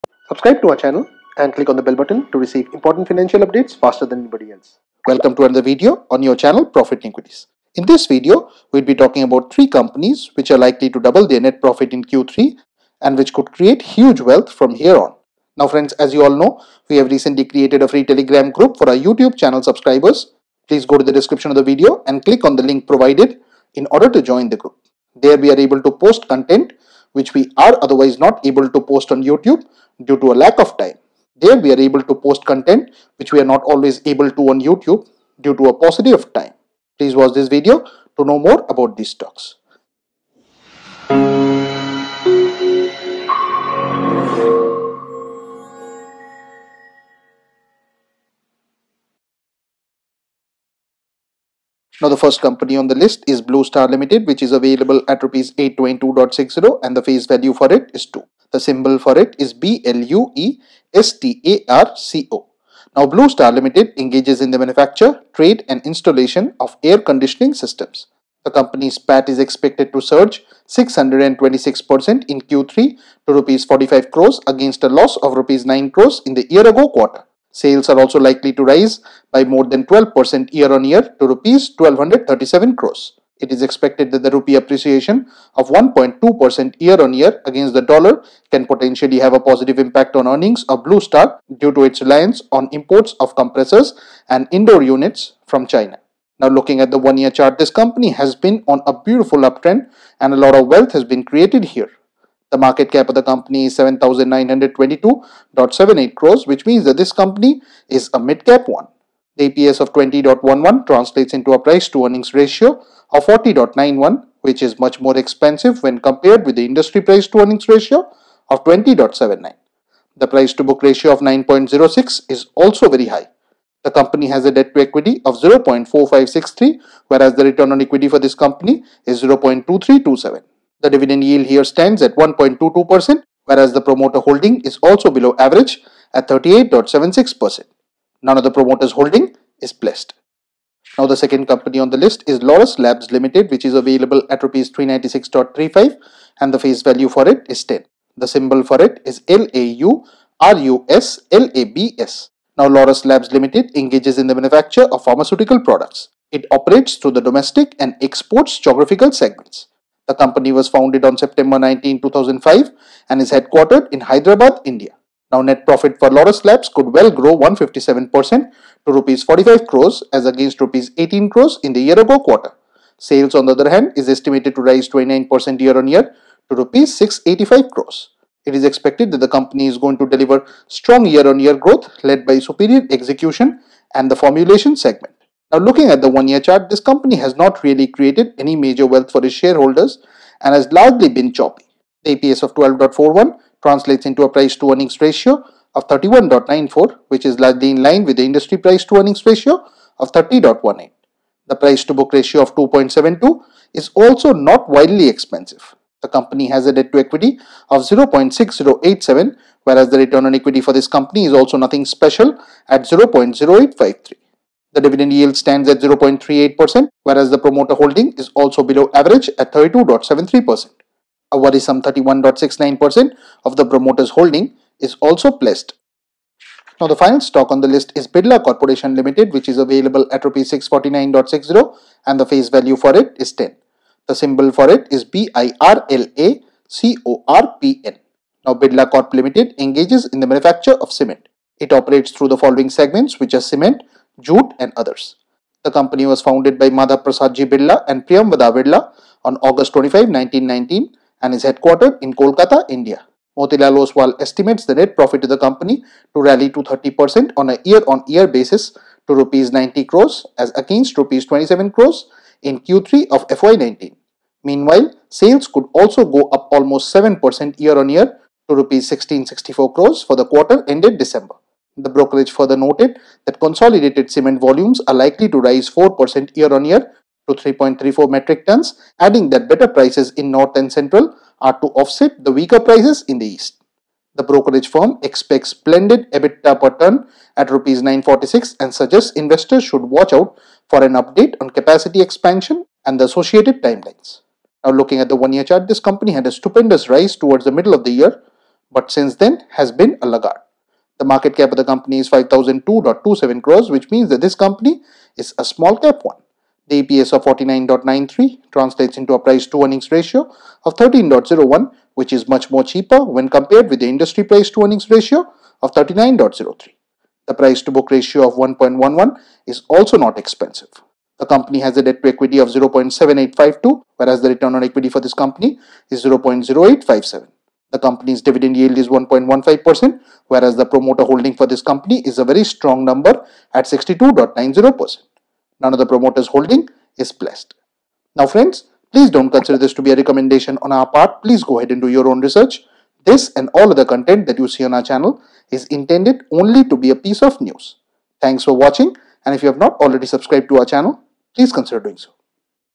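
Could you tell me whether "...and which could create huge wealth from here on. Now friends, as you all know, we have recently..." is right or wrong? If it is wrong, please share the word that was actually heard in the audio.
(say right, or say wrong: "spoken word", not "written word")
right.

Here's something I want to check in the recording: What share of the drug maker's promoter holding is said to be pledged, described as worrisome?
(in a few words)
31.69%.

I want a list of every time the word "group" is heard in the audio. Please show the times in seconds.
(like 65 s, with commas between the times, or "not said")
18 s, 24 s.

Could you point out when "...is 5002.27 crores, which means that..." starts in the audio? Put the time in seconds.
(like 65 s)
301 s.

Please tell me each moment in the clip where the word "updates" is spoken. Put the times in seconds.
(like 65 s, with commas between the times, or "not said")
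3 s, 290 s.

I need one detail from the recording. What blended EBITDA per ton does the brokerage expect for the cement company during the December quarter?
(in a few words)
Rs 946.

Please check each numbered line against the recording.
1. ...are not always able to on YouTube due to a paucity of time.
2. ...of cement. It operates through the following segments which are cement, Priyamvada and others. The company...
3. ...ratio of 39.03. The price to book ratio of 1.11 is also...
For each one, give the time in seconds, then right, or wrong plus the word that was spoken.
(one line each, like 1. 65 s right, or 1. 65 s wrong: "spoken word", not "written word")
1. 33 s right
2. 240 s wrong: "Jute", not "Priyamvada"
3. 314 s right.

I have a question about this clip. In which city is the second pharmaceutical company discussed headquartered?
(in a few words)
Hyderabad.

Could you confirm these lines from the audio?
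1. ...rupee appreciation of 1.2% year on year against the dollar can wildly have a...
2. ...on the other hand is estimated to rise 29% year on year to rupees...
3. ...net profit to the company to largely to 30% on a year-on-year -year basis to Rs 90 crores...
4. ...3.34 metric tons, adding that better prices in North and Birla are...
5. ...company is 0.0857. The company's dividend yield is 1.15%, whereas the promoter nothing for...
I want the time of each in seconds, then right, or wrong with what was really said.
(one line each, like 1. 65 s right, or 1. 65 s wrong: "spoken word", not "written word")
1. 84 s wrong: "potentially", not "wildly"
2. 173 s right
3. 254 s wrong: "rally", not "largely"
4. 277 s wrong: "Central", not "Birla"
5. 325 s wrong: "holding", not "nothing".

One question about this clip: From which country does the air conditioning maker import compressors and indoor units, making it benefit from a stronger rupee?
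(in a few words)
China.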